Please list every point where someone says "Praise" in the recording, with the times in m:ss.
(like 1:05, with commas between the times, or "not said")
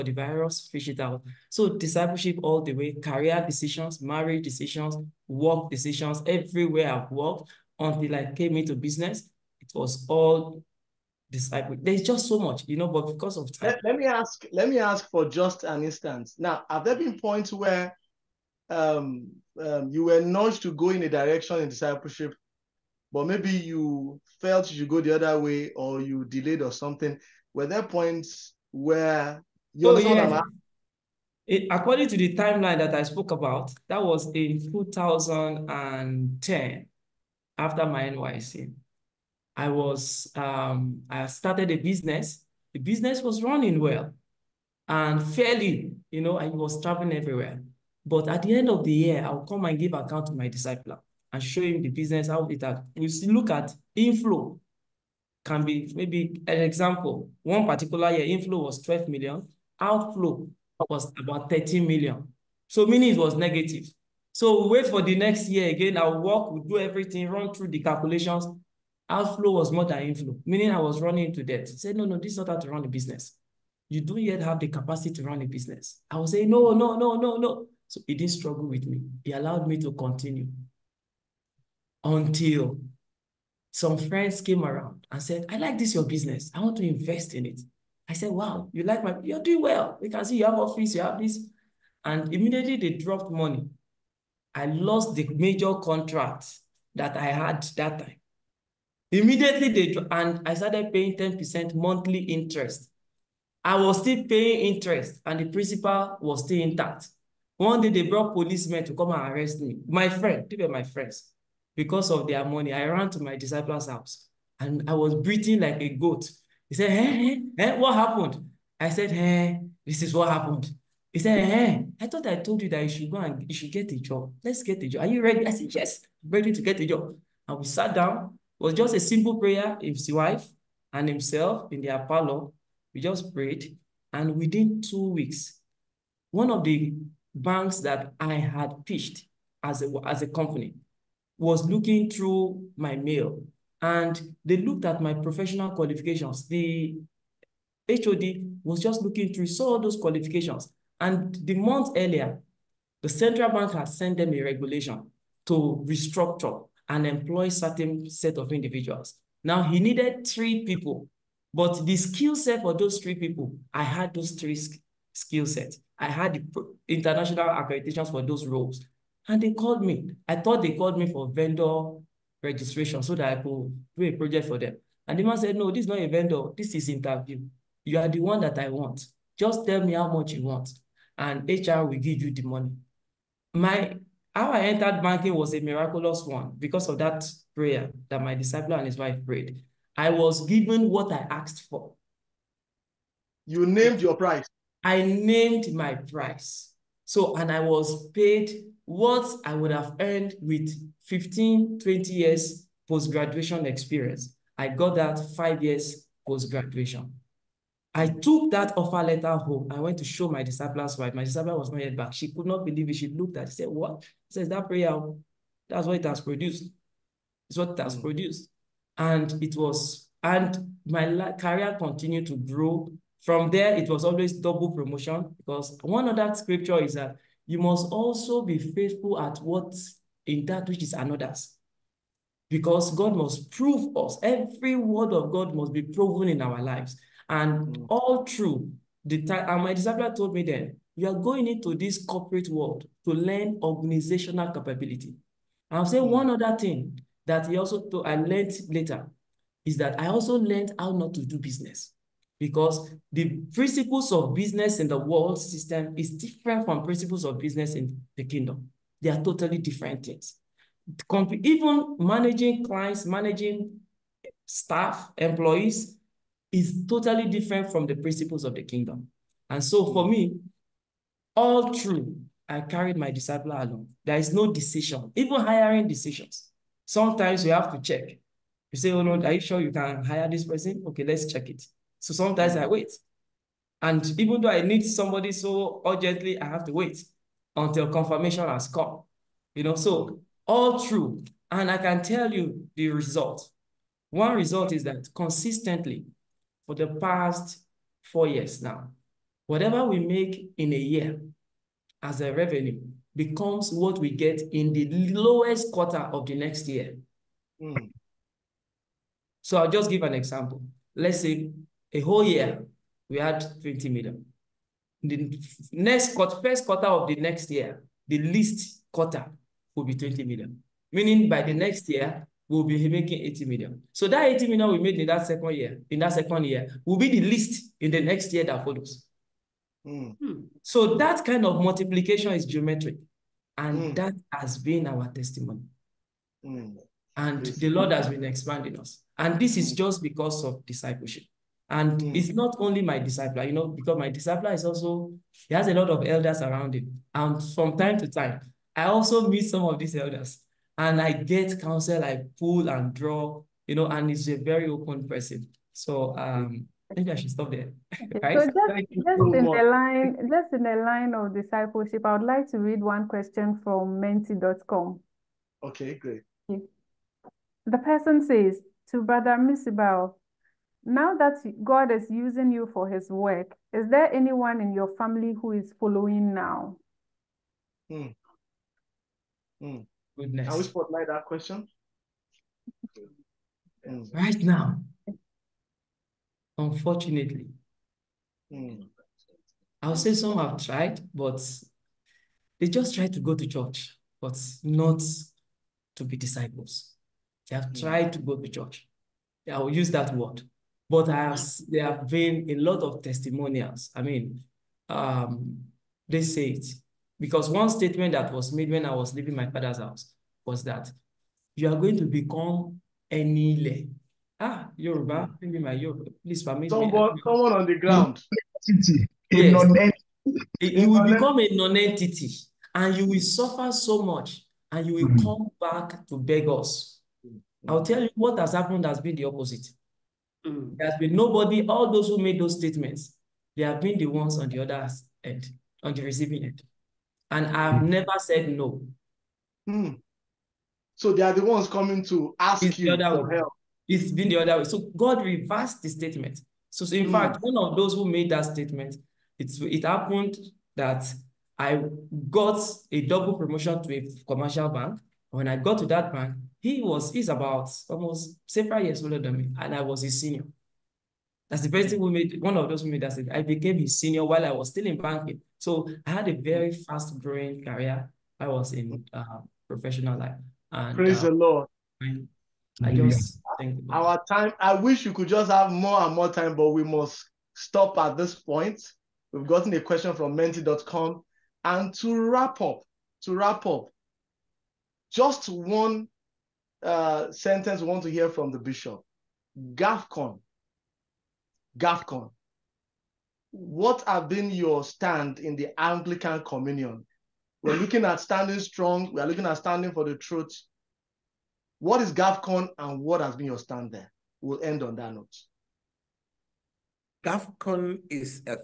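7:50.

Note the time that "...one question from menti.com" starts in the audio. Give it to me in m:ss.
6:02.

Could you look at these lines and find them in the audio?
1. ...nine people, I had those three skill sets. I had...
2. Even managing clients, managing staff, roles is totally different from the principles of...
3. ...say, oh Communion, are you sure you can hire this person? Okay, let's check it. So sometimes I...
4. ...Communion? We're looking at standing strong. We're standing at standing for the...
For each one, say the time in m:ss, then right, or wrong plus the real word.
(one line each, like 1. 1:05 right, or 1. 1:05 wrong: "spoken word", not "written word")
1. 2:42 wrong: "three", not "nine"
2. 4:21 wrong: "employees", not "roles"
3. 4:38 wrong: "Lord", not "Communion"
4. 8:16 wrong: "looking", not "standing".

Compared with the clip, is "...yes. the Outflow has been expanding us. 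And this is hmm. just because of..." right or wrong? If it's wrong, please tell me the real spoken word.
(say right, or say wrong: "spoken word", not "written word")
wrong: "Lord", not "Outflow".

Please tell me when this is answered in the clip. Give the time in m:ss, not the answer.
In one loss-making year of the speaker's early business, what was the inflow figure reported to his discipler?
0:58.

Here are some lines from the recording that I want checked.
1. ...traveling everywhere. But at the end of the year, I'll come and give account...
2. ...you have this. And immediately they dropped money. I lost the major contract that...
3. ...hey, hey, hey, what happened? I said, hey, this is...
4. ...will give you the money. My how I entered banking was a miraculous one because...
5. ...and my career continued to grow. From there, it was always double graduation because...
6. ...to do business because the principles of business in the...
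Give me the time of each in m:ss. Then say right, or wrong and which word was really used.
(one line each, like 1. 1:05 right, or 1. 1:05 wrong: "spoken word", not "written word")
1. 0:46 right
2. 1:30 right
3. 1:56 right
4. 3:01 right
5. 3:40 wrong: "promotion", not "graduation"
6. 4:11 right.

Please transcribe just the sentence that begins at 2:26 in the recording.
The HOD was just looking through, saw those qualifications.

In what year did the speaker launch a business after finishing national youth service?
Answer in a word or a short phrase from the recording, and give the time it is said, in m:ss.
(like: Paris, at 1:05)
2010, at 0:34.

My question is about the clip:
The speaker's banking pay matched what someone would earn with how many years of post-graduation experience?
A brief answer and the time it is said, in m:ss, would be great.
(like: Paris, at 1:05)
15 to 20 years, at 3:21.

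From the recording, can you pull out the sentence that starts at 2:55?
And the man said, no, this is not a vendor.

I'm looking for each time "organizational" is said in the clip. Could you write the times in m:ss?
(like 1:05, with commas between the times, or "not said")
4:03.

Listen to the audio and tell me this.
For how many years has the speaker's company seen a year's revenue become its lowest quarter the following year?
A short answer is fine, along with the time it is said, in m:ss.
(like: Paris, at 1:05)
4 years, at 4:58.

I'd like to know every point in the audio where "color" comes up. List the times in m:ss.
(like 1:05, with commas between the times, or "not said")
not said.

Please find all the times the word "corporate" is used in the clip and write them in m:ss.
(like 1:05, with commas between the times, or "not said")
4:02.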